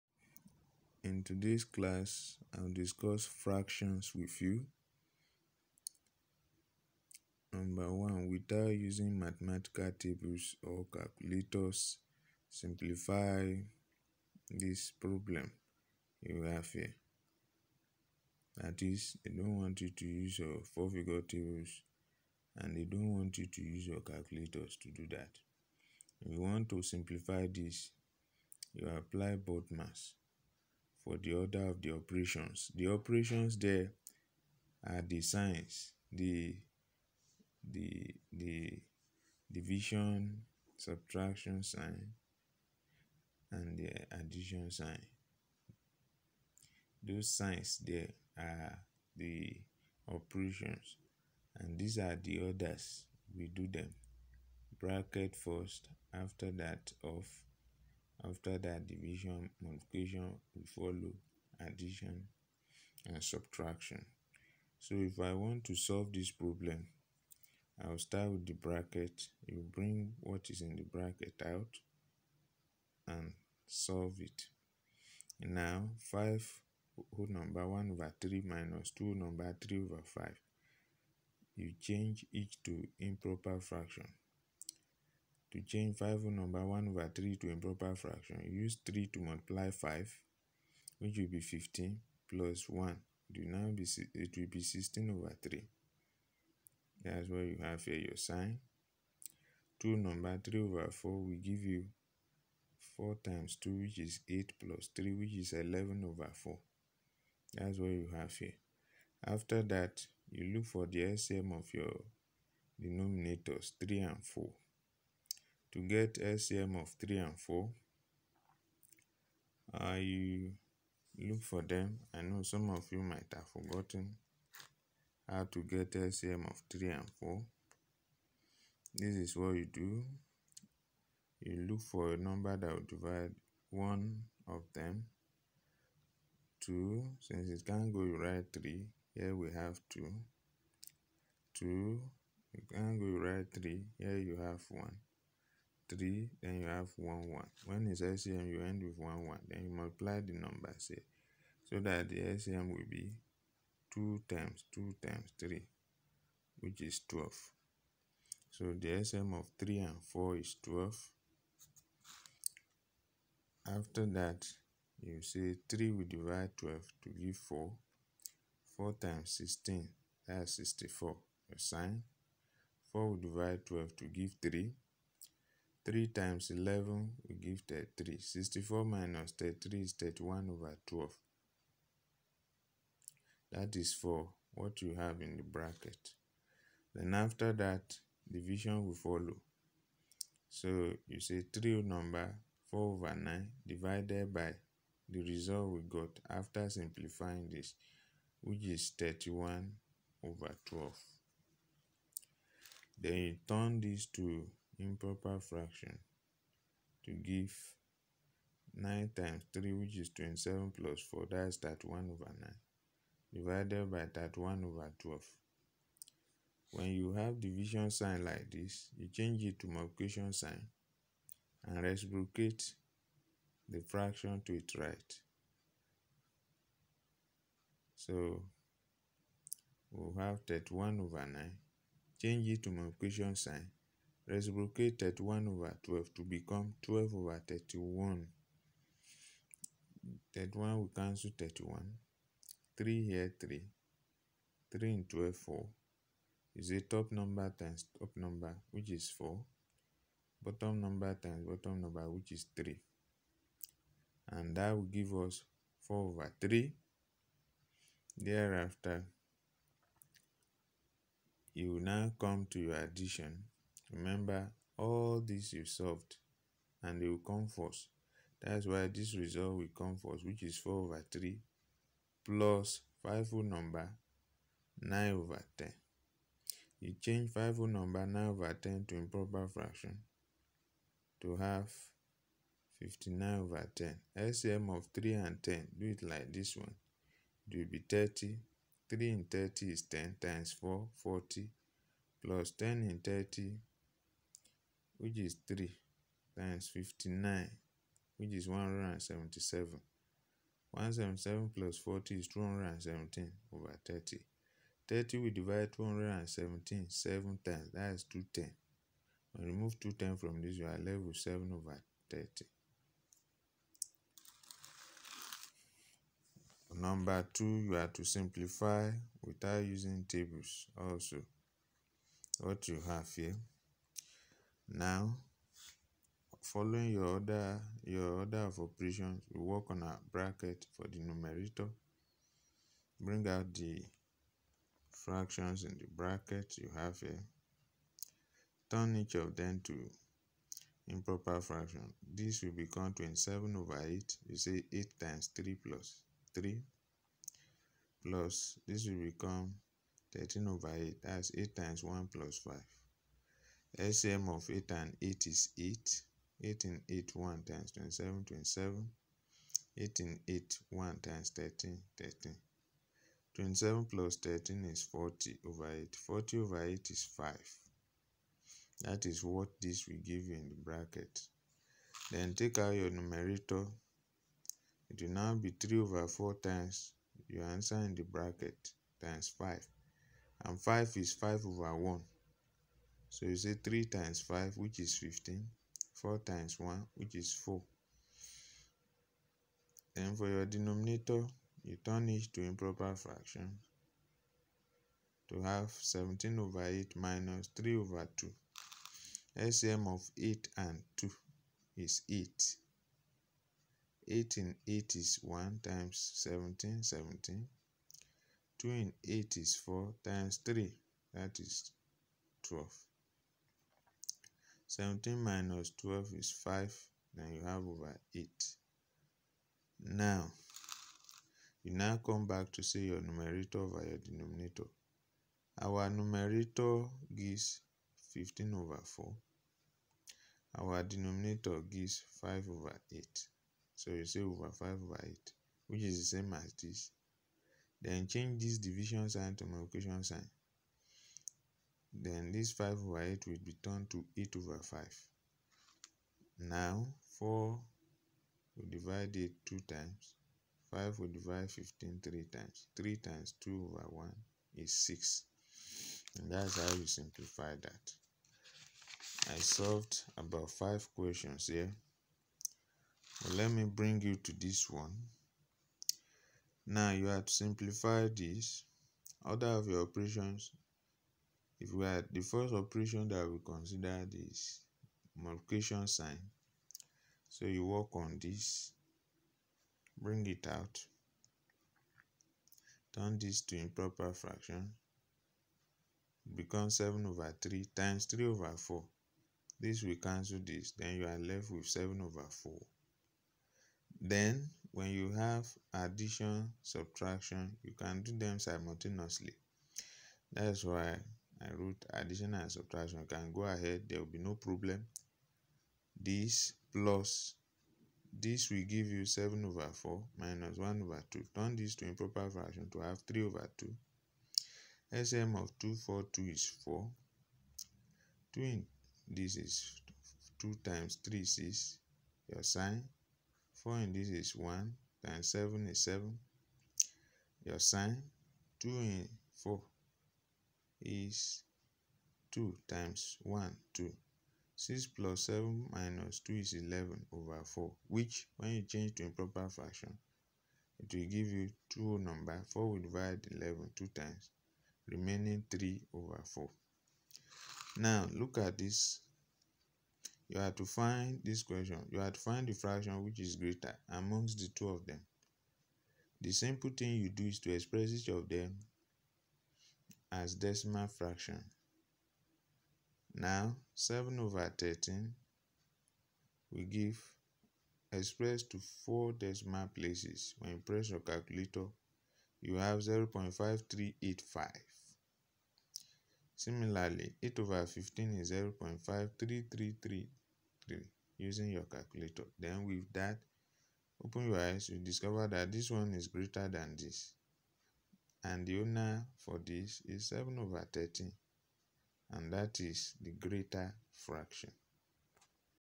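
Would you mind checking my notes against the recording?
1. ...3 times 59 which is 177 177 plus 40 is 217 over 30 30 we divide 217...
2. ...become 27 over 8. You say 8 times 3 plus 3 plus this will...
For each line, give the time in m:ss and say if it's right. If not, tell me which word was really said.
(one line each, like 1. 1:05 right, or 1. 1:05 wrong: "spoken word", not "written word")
1. 4:55 right
2. 5:42 right.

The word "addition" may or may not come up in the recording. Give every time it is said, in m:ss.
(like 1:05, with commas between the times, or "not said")
0:44, 1:01, 4:22, 8:15, 8:21.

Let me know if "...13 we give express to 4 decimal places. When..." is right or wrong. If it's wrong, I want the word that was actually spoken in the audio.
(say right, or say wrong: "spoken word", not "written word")
right.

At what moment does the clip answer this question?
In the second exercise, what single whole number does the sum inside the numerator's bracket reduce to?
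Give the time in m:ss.
6:05.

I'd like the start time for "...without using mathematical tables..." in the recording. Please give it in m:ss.
0:08.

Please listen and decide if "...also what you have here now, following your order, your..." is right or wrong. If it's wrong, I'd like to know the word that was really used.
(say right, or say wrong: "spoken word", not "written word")
right.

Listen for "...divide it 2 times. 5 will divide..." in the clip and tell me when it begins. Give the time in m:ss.
7:28.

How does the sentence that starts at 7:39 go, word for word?
I solved about 5 questions here.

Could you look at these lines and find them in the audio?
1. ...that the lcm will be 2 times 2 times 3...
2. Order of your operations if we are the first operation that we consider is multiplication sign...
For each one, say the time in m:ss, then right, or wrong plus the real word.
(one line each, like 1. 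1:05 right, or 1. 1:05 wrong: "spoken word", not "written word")
1. 2:31 right
2. 7:49 right.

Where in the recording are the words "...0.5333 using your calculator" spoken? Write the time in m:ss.
9:38.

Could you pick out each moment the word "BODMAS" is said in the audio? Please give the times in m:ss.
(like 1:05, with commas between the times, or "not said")
0:29.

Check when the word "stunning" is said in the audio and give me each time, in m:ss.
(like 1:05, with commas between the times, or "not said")
not said.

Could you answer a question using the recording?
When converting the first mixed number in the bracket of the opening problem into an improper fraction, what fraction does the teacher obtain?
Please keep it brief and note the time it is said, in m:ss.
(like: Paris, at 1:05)
16/3, at 1:34.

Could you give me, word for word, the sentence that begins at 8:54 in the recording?
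6 plus 7 minus 2 is 11 over 4, which, when you change to improper fraction, it will give you two number.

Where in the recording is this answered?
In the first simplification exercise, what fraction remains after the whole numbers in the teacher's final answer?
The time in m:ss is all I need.
5:11.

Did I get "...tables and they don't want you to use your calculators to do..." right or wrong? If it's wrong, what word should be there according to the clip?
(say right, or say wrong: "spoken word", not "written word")
right.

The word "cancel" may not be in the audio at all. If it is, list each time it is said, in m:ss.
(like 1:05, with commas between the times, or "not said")
4:00, 8:10.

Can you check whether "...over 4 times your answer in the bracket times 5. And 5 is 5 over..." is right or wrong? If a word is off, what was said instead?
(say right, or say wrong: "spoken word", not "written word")
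right.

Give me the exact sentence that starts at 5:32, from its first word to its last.
Bring out the fractions in the bracket you have here.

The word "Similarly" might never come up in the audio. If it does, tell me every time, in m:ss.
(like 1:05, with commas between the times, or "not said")
9:36.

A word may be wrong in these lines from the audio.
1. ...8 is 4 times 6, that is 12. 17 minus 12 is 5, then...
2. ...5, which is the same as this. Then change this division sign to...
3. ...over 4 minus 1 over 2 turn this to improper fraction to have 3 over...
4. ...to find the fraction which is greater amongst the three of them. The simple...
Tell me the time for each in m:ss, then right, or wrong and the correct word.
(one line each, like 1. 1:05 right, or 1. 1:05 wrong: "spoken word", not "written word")
1. 6:49 wrong: "3", not "6"
2. 7:15 wrong: "8", not "5"
3. 8:29 right
4. 9:12 wrong: "two", not "three".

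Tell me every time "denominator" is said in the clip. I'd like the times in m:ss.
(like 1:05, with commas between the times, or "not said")
1:52, 6:30, 7:03, 7:10.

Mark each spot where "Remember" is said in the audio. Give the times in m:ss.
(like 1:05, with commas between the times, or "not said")
4:23.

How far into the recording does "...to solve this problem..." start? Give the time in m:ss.
1:05.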